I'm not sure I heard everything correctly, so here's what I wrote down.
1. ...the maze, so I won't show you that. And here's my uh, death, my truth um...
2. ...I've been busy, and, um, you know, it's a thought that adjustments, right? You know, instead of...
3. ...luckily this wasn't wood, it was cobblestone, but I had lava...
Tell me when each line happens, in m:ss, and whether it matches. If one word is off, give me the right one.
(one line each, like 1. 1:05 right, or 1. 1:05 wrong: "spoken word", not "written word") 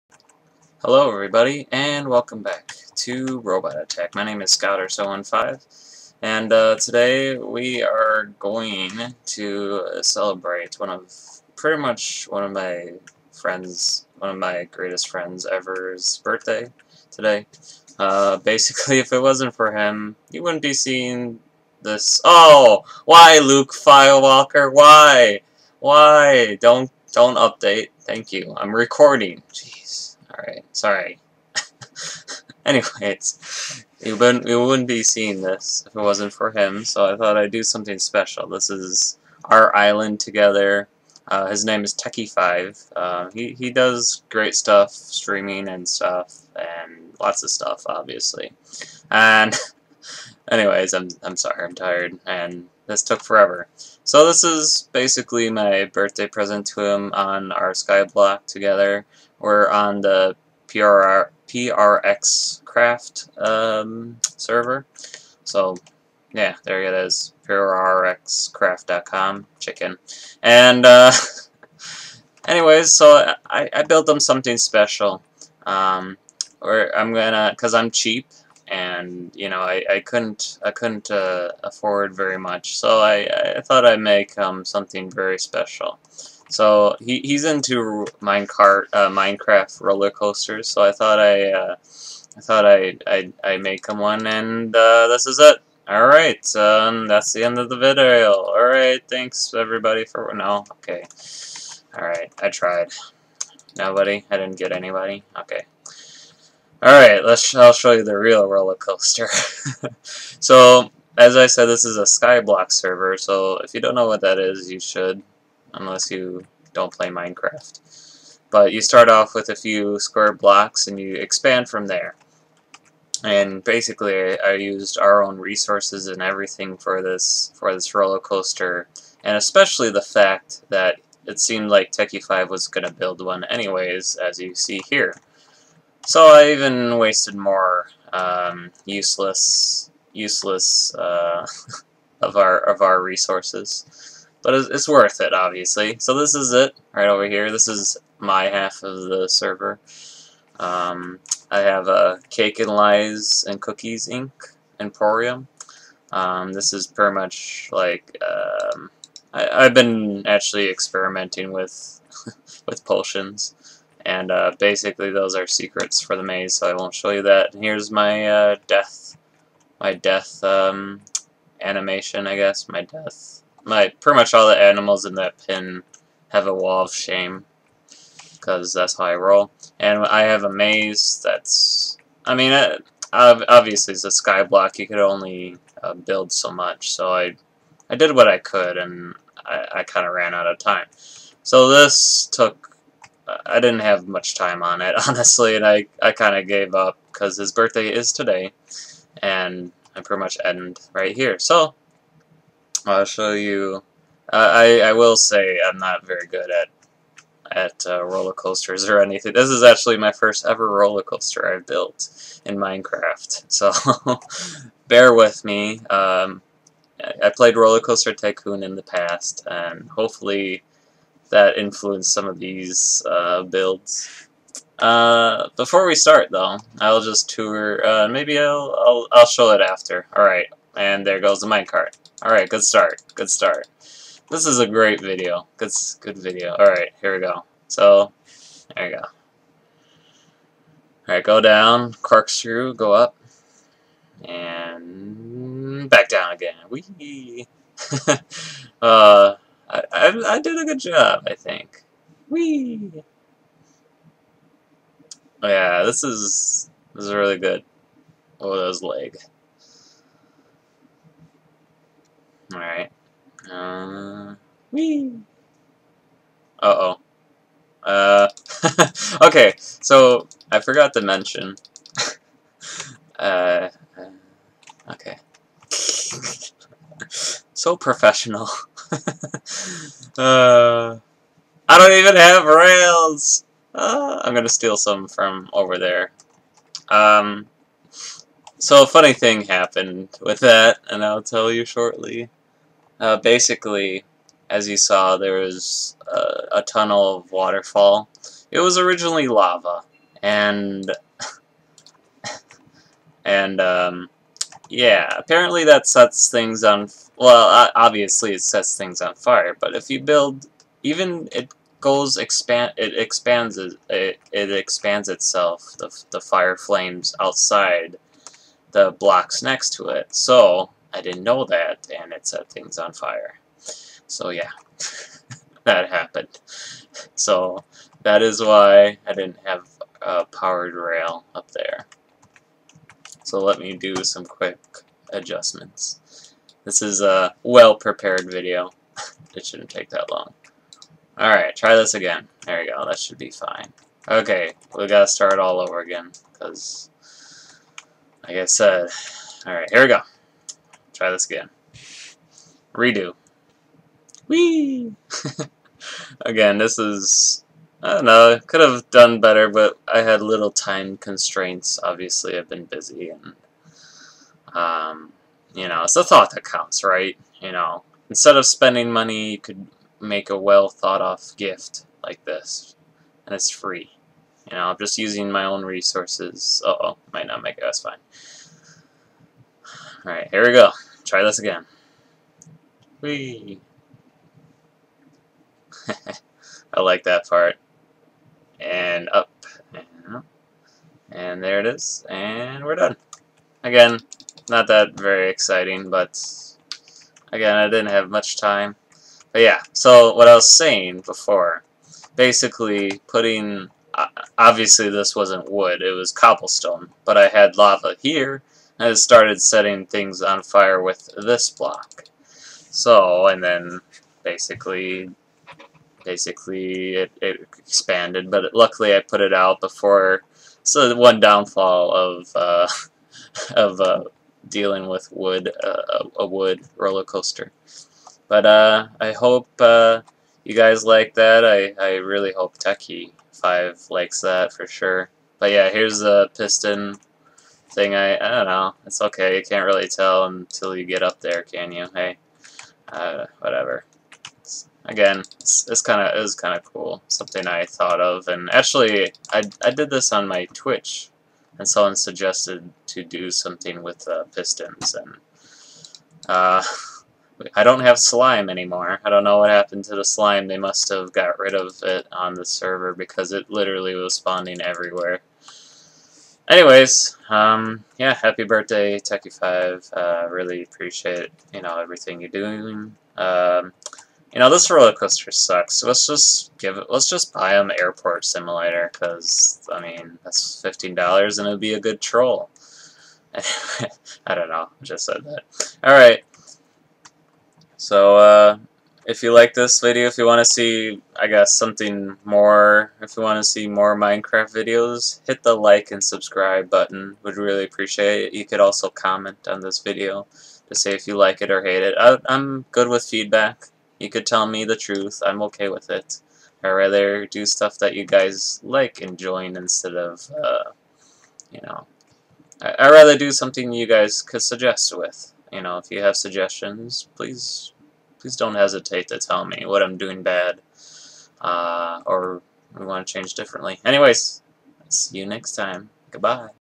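1. 2:46 wrong: "death", not "truth"
2. 6:02 wrong: "counts", not "adjustments"
3. 6:44 wrong: "obviously", not "luckily".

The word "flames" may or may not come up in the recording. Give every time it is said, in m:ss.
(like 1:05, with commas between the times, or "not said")
5:16.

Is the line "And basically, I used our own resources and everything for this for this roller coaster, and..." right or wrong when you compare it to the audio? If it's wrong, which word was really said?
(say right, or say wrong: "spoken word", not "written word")
right.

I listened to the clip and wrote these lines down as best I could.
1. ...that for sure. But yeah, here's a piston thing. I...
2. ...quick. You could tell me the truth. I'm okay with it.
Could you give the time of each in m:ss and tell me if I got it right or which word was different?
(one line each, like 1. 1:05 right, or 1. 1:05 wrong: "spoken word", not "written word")
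1. 7:14 right
2. 8:23 wrong: "feedback", not "quick".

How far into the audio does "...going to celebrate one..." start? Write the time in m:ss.
0:08.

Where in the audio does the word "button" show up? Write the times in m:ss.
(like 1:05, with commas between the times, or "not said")
8:16.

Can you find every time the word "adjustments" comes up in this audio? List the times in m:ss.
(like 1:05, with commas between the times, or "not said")
5:35.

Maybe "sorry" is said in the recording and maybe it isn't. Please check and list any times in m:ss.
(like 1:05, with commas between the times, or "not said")
0:30, 0:51.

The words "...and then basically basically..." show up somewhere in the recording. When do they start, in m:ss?
6:53.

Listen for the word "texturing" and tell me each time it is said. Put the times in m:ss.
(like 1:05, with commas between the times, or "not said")
not said.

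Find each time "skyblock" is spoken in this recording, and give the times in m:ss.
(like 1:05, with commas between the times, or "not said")
0:57, 1:52.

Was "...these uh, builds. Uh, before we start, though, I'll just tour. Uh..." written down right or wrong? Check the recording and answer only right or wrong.
right.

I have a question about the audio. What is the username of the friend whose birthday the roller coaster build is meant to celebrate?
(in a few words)
Techie5.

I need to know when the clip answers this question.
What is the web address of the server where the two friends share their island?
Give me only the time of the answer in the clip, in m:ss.
1:07.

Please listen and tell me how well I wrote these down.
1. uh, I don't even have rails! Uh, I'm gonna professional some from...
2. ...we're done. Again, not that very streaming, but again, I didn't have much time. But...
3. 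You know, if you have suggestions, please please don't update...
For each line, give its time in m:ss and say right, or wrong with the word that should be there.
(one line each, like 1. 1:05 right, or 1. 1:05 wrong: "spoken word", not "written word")
1. 4:40 wrong: "steal", not "professional"
2. 6:32 wrong: "exciting", not "streaming"
3. 8:35 wrong: "hesitate", not "update".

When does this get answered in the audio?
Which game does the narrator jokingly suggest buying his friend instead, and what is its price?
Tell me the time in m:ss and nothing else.
7:57.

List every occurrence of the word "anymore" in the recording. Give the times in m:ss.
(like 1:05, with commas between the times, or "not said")
7:38.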